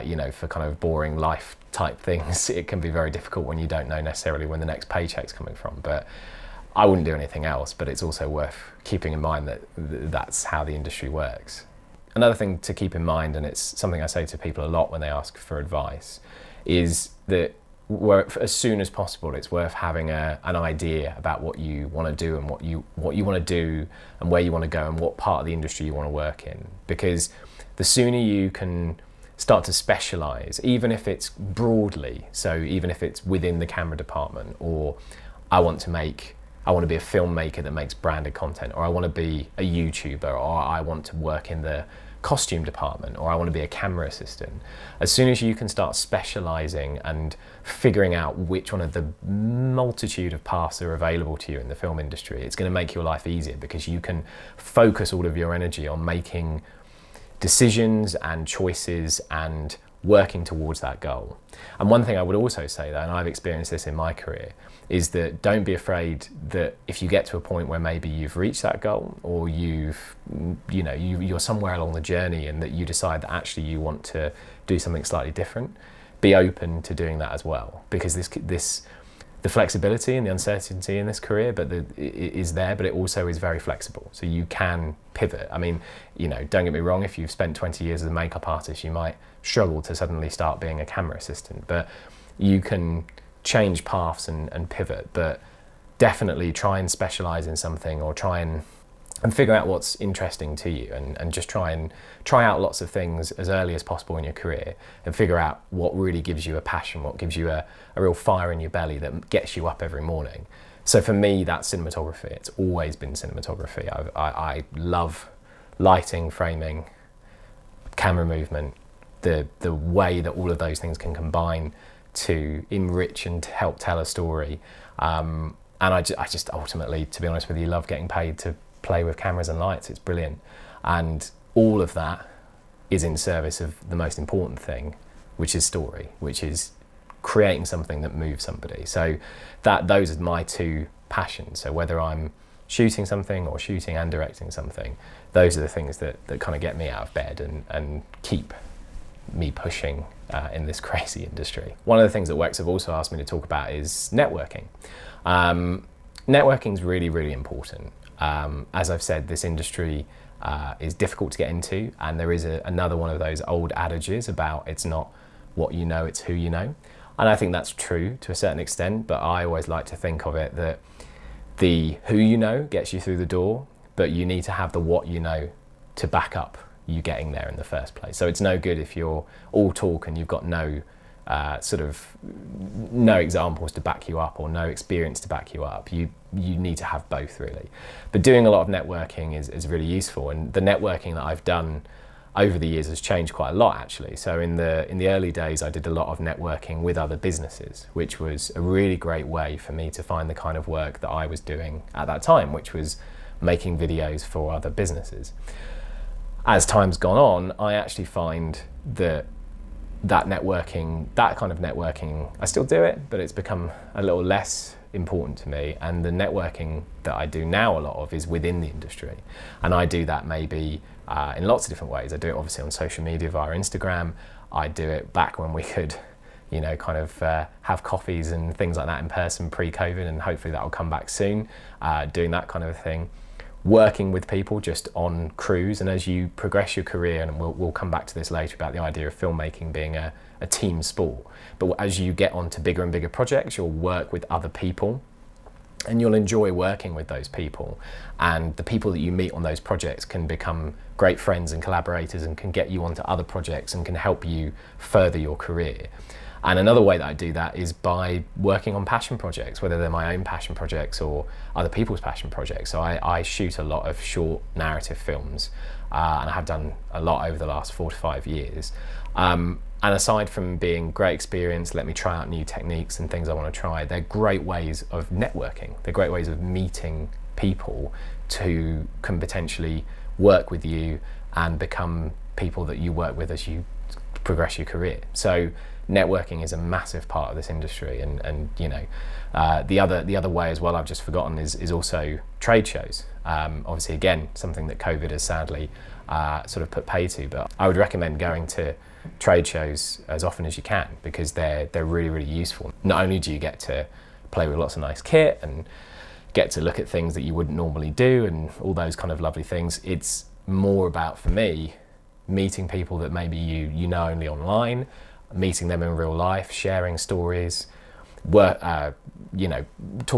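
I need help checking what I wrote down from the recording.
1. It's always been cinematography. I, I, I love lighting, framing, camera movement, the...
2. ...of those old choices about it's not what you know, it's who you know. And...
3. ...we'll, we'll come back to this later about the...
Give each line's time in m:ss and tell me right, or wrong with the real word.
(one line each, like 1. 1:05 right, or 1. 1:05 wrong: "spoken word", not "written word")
1. 1:52 right
2. 2:43 wrong: "adages", not "choices"
3. 3:57 right.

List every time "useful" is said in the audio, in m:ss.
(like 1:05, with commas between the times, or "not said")
3:09, 5:02.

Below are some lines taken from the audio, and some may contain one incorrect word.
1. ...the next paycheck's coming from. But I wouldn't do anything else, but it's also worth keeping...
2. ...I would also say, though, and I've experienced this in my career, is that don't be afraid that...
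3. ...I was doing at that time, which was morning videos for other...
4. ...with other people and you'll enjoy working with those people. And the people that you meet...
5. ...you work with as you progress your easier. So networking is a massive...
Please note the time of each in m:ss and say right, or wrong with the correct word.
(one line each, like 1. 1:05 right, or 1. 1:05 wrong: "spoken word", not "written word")
1. 0:04 right
2. 1:02 right
3. 3:21 wrong: "making", not "morning"
4. 4:04 right
5. 4:42 wrong: "career", not "easier".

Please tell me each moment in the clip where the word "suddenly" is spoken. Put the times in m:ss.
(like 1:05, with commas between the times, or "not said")
1:29.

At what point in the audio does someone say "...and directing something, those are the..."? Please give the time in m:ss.
2:23.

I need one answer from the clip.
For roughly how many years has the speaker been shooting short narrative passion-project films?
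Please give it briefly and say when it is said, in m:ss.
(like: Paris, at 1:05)
4 to 5 years, at 4:27.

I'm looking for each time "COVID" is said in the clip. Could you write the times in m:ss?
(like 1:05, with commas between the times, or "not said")
3:49, 4:54.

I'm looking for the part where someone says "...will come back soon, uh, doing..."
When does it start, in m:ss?
3:50.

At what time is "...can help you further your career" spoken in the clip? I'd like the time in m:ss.
4:13.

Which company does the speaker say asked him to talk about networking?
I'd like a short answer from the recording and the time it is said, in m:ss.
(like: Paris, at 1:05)
Wex, at 2:32.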